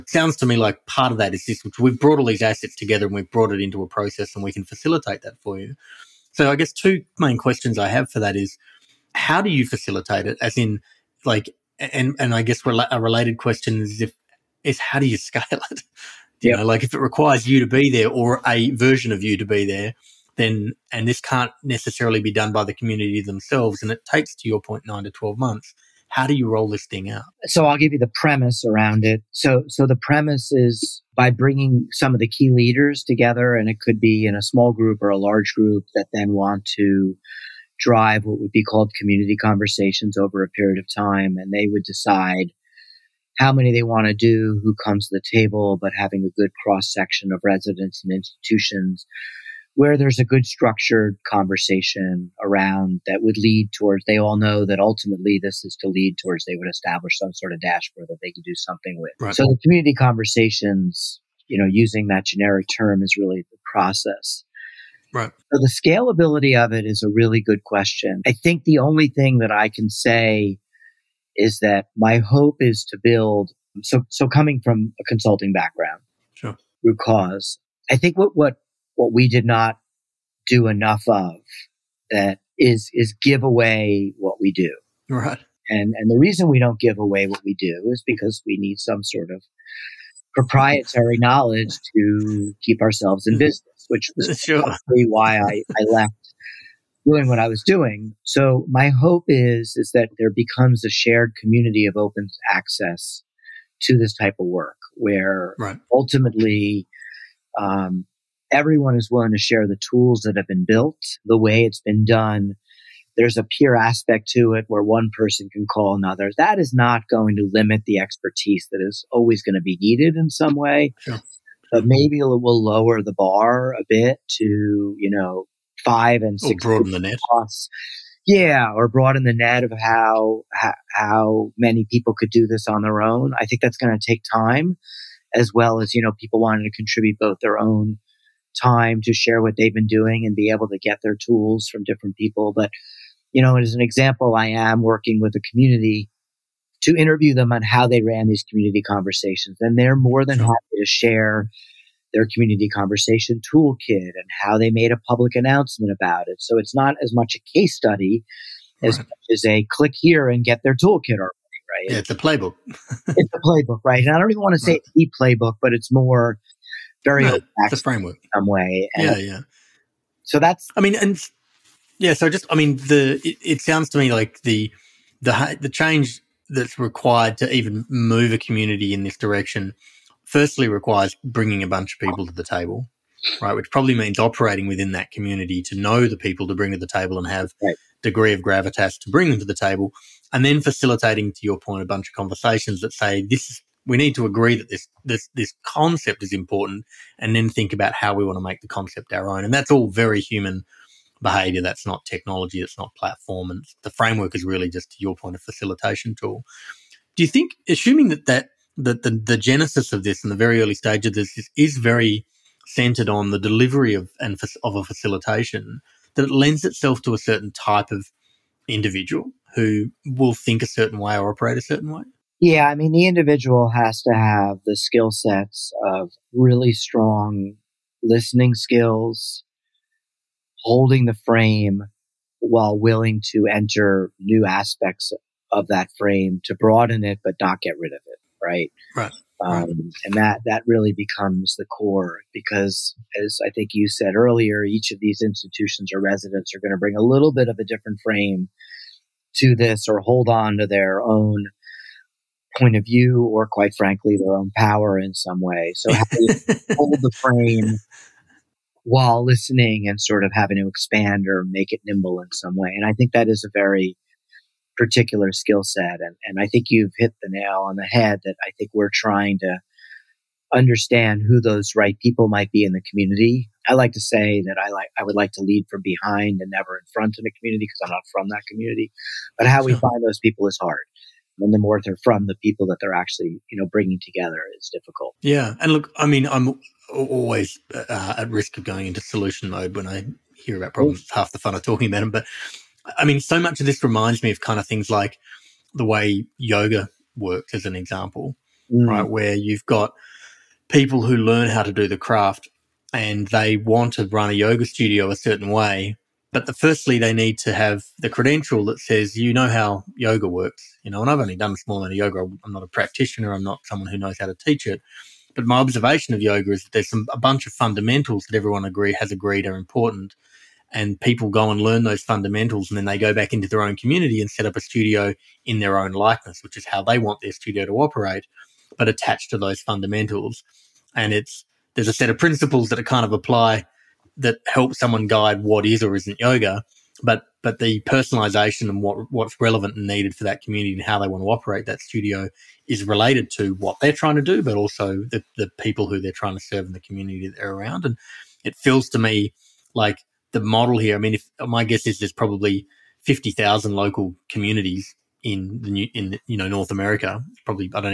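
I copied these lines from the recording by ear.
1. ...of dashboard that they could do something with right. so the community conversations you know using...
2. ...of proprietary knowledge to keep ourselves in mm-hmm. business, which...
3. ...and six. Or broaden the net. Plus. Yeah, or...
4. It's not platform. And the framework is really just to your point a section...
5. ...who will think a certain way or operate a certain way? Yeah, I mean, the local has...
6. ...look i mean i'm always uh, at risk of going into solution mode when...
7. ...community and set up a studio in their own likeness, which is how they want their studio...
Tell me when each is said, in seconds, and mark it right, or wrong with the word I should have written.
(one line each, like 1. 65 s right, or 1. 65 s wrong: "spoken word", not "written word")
1. 57 s right
2. 89 s right
3. 126 s right
4. 202 s wrong: "facilitation", not "section"
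5. 219 s wrong: "individual", not "local"
6. 285 s right
7. 323 s right.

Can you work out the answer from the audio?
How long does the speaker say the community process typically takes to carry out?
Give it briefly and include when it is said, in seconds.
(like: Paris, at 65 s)
9 to 12 months, at 24 s.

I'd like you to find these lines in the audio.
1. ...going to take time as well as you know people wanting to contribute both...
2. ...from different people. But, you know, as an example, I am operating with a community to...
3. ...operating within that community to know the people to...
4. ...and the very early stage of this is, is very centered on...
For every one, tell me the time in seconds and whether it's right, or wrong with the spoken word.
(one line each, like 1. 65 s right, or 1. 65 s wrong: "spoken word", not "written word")
1. 133 s right
2. 141 s wrong: "working", not "operating"
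3. 184 s right
4. 210 s right.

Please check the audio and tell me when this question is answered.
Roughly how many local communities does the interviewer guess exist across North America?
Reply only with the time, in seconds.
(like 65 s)
353 s.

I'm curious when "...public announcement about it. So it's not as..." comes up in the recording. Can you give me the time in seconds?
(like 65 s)
155 s.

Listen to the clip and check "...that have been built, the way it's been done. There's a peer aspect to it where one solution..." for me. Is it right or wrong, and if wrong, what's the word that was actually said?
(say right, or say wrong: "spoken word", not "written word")
wrong: "person", not "solution".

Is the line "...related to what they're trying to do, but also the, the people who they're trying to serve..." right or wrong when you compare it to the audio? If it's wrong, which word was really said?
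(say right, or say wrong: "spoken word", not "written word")
right.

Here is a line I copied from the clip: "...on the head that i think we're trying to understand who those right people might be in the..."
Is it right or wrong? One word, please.
right.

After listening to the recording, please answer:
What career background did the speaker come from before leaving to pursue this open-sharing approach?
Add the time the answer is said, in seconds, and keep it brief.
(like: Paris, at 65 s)
consulting, at 75 s.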